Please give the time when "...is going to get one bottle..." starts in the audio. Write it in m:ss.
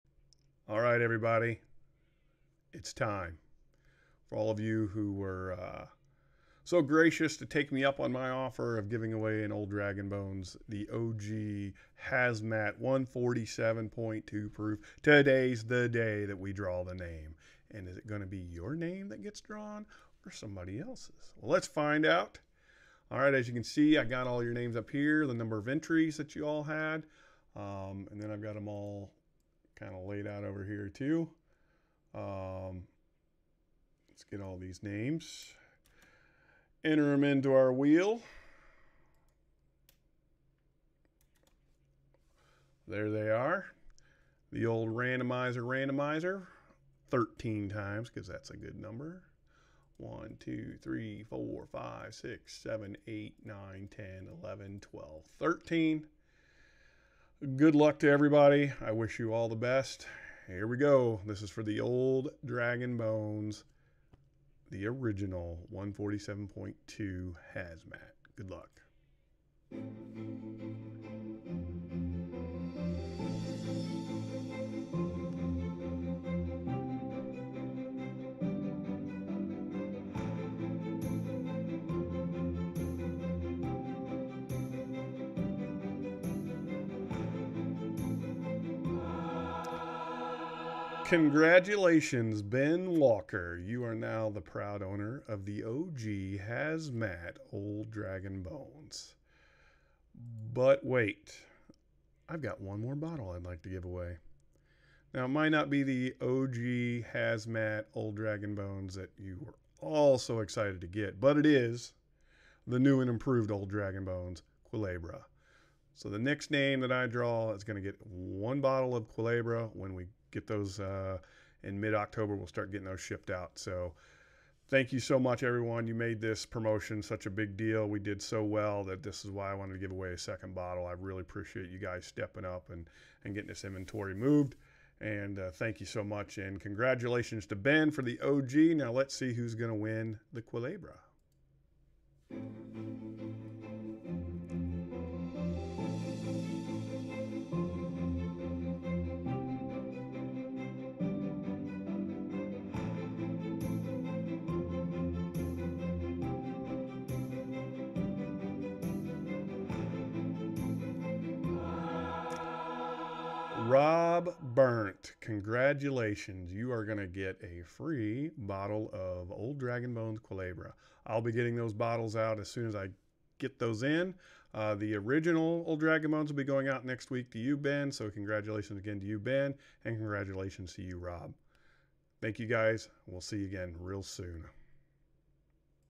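1:57.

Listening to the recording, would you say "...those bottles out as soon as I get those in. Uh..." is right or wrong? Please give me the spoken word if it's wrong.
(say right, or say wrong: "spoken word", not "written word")
right.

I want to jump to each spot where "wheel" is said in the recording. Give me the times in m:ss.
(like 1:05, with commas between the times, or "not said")
0:37.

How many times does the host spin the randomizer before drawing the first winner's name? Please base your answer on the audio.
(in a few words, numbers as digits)
13.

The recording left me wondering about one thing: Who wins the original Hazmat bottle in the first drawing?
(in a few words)
Ben Walker.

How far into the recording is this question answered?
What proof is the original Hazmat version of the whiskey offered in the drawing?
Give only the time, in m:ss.
0:12.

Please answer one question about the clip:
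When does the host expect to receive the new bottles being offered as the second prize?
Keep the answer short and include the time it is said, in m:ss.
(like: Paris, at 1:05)
Mid October, at 2:01.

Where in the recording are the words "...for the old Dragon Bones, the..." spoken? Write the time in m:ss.
1:01.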